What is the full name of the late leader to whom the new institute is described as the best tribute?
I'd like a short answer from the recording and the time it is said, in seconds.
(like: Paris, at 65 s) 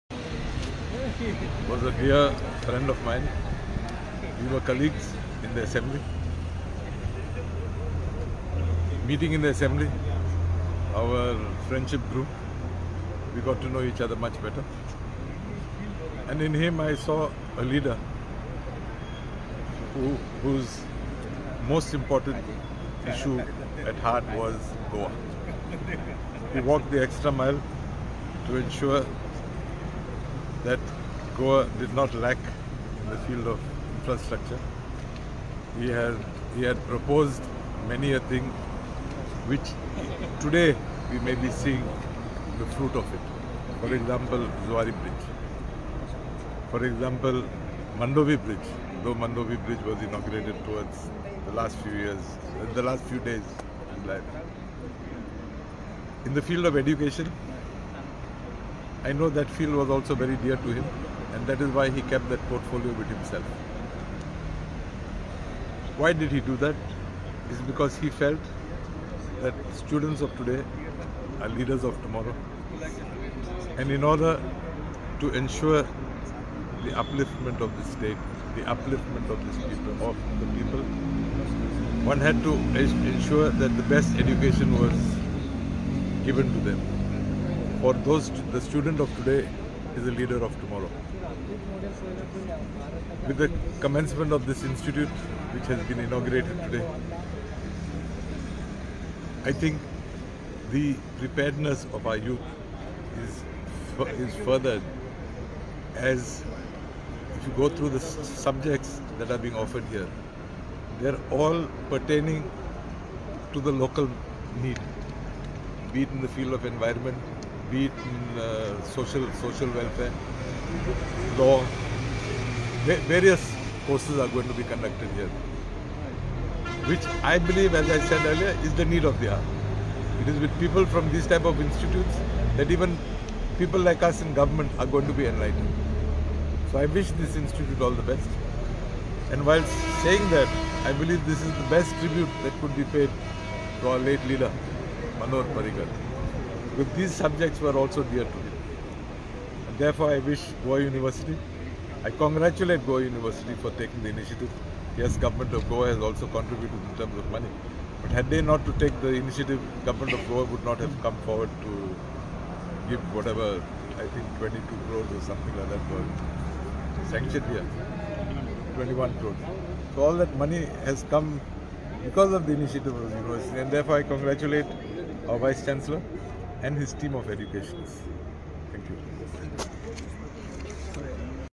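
Manohar Parrikar, at 145 s.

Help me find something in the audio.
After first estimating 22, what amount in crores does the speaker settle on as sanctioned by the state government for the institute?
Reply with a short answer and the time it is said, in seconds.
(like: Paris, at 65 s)
21 crores, at 168 s.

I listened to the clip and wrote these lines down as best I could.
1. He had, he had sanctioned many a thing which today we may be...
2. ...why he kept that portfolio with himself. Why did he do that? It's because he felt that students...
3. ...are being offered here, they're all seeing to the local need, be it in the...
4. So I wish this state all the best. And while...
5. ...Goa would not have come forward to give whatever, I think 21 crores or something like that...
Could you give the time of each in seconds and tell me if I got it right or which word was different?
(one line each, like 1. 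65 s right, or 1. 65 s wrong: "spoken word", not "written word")
1. 35 s wrong: "proposed", not "sanctioned"
2. 61 s right
3. 109 s wrong: "pertaining", not "seeing"
4. 136 s wrong: "institute", not "state"
5. 160 s wrong: "22", not "21".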